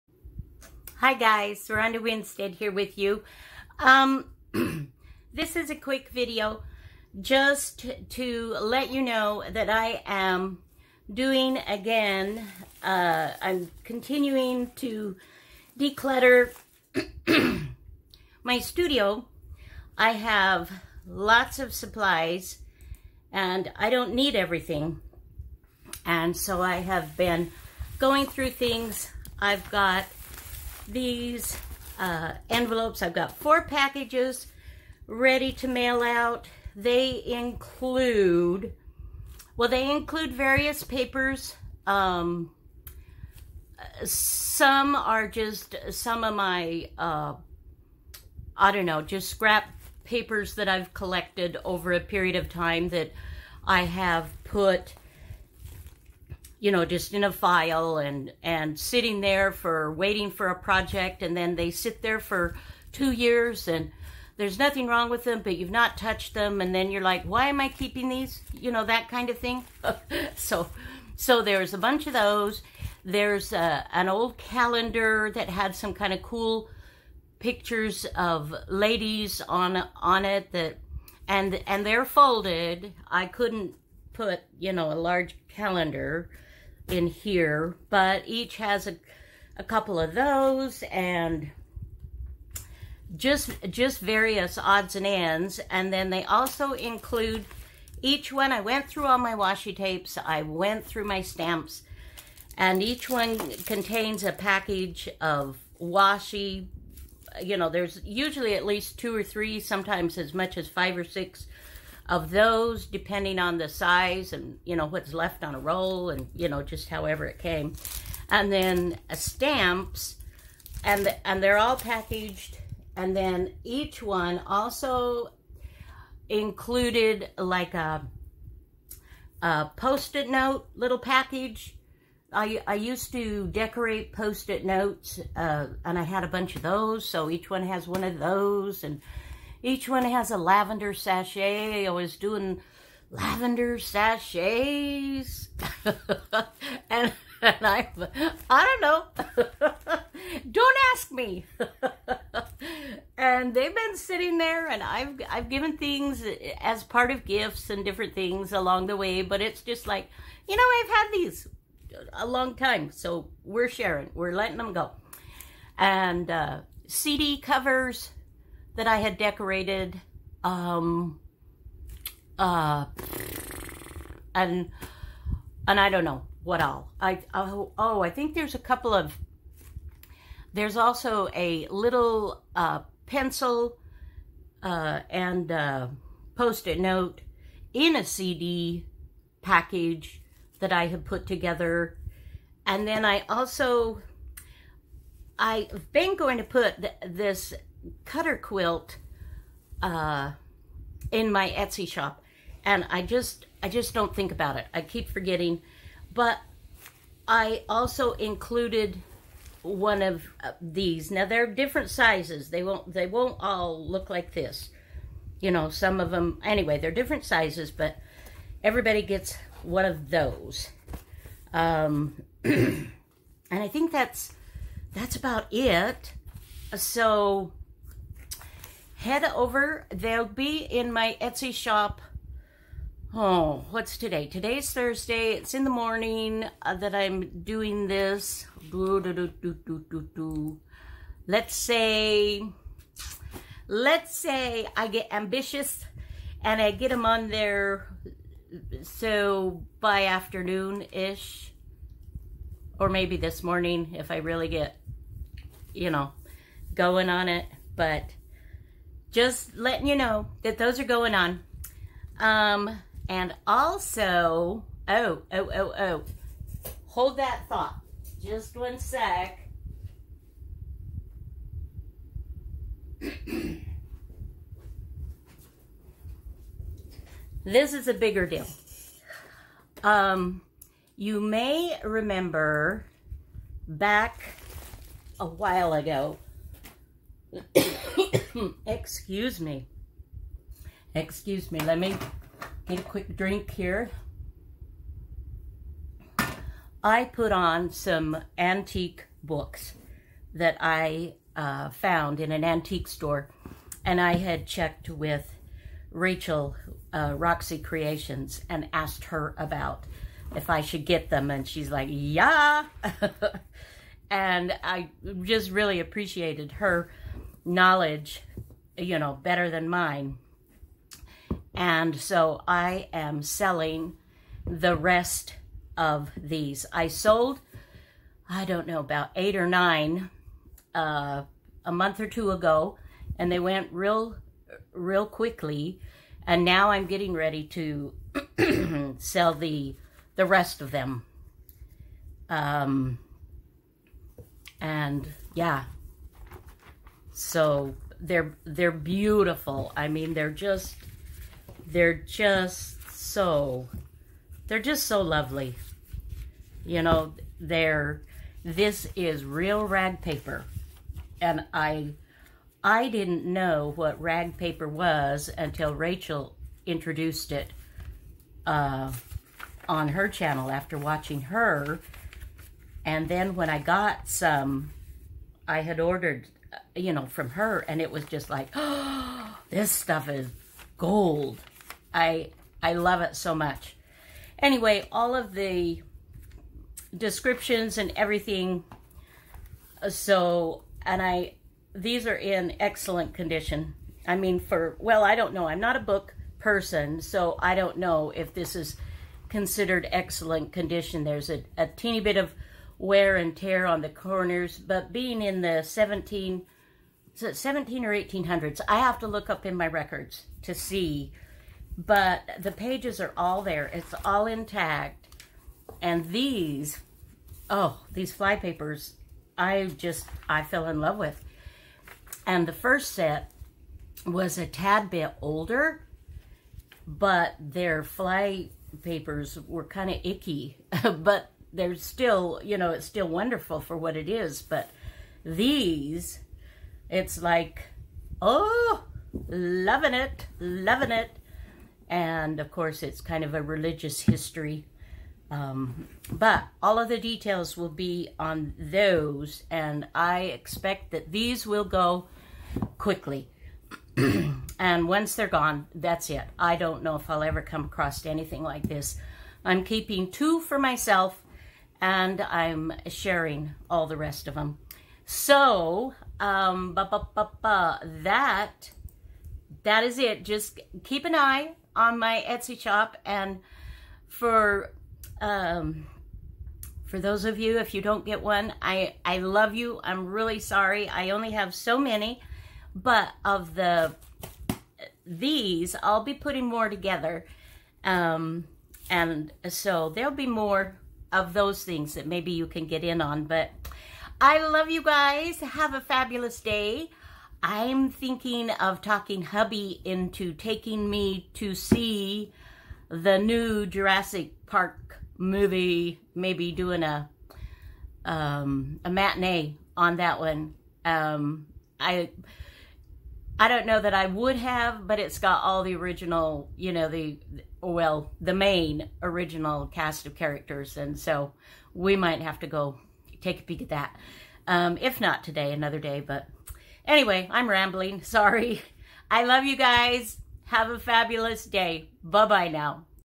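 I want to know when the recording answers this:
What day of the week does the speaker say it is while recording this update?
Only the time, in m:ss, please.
3:54.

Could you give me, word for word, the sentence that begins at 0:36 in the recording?
They include, well, they include various papers.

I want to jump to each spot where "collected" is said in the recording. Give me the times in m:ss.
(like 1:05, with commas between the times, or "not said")
0:50.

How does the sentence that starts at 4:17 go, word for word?
But just letting you know that those are going on.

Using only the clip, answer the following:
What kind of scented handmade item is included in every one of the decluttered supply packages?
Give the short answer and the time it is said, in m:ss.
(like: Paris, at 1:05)
Lavender sachet, at 2:20.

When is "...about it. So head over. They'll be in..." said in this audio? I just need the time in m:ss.
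3:45.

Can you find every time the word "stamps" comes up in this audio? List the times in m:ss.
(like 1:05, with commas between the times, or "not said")
1:41, 1:59.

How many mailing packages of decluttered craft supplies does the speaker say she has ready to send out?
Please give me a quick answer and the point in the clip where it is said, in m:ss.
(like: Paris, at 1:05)
4, at 0:33.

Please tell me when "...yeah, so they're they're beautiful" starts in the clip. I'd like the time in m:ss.
5:45.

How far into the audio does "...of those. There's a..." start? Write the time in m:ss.
1:12.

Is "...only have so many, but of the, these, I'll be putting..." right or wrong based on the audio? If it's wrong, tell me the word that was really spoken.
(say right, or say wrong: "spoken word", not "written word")
right.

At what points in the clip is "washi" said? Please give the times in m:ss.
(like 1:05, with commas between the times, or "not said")
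1:39, 1:45.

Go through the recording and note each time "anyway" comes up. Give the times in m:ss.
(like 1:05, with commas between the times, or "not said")
3:36, 6:24, 8:46.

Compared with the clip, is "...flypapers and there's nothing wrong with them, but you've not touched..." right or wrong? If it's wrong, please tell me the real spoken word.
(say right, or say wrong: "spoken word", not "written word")
wrong: "years", not "flypapers".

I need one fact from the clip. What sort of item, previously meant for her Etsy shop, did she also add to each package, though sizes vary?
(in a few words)
Cutter quilt.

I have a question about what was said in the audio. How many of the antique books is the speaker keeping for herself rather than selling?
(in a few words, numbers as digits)
2.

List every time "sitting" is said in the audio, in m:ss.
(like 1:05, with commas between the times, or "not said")
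0:58, 2:33.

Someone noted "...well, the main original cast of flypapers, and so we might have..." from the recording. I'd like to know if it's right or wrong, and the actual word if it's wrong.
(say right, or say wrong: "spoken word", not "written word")
wrong: "characters", not "flypapers".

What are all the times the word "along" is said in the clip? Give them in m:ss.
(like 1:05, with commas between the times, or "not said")
2:38.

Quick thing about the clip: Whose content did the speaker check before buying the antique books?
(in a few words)
Roxy Creations.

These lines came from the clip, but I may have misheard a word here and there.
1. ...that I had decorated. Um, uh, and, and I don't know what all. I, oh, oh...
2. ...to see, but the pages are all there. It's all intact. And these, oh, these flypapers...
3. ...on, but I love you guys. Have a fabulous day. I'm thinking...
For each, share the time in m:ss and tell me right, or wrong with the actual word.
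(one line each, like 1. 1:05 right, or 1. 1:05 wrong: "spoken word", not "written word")
1. 2:48 right
2. 6:50 right
3. 8:13 right.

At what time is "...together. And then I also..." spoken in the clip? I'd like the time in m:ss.
3:11.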